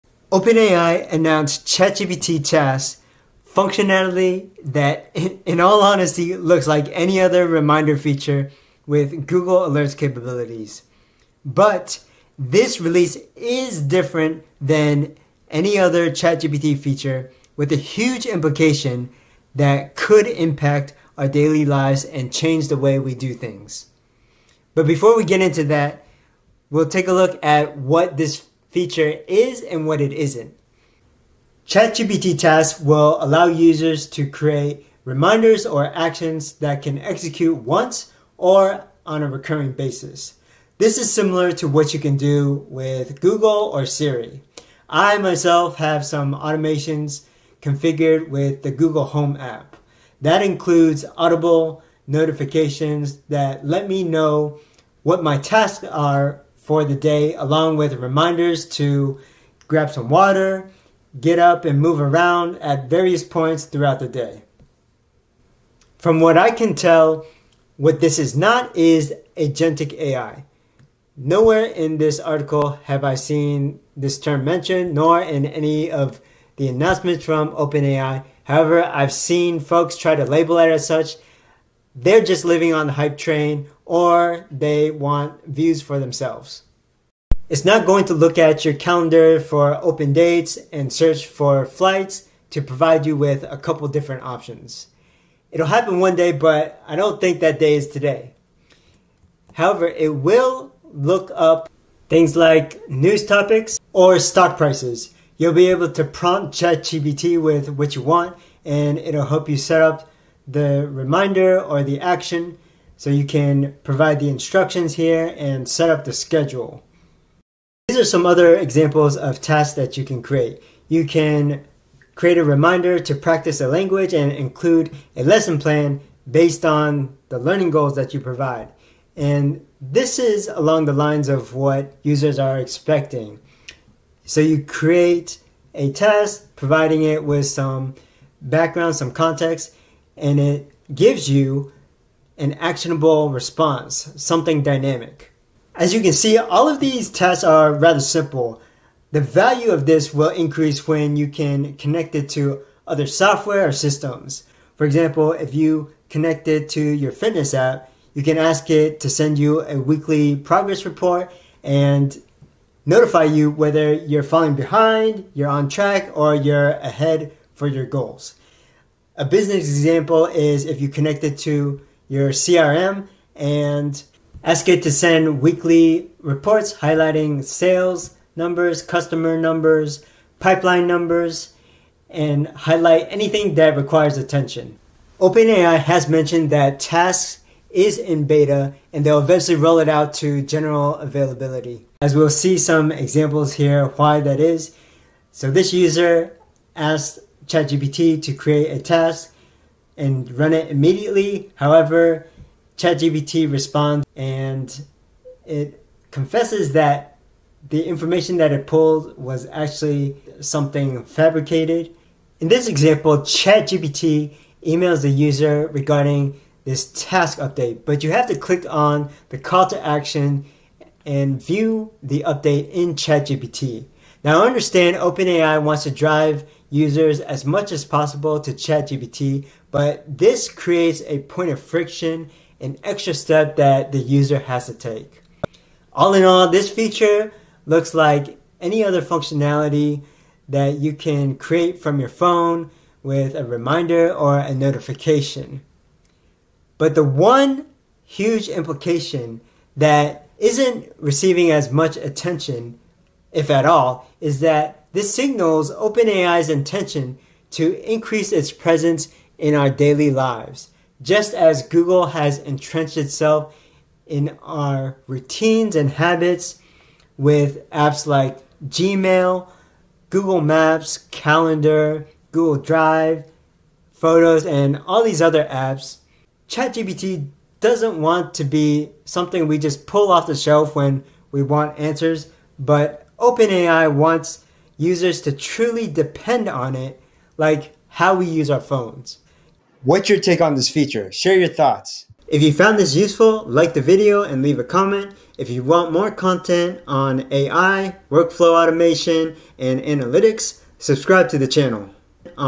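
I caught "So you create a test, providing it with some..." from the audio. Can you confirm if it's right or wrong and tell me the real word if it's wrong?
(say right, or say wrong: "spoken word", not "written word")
right.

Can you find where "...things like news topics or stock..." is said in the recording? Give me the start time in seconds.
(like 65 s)
102 s.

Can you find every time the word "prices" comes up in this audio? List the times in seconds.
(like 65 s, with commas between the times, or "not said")
104 s.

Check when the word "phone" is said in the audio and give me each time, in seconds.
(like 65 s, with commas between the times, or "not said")
242 s, 288 s.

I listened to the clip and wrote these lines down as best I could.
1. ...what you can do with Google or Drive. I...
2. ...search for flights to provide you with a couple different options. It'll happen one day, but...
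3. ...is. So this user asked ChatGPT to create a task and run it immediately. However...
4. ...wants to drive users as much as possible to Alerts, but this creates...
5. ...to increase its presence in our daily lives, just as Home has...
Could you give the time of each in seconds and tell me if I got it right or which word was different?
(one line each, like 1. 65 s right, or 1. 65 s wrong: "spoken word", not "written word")
1. 41 s wrong: "Siri", not "Drive"
2. 90 s right
3. 194 s right
4. 225 s wrong: "ChatGPT", not "Alerts"
5. 257 s wrong: "Google", not "Home".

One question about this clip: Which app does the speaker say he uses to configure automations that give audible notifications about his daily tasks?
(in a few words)
Google Home.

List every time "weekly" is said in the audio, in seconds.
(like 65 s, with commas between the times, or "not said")
159 s, 175 s.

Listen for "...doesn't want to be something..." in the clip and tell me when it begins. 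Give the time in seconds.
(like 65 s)
277 s.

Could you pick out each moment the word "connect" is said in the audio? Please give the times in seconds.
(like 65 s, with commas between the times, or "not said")
151 s, 156 s, 170 s.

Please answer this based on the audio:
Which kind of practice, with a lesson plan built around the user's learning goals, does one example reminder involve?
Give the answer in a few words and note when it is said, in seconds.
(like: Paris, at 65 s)
practice a language, at 123 s.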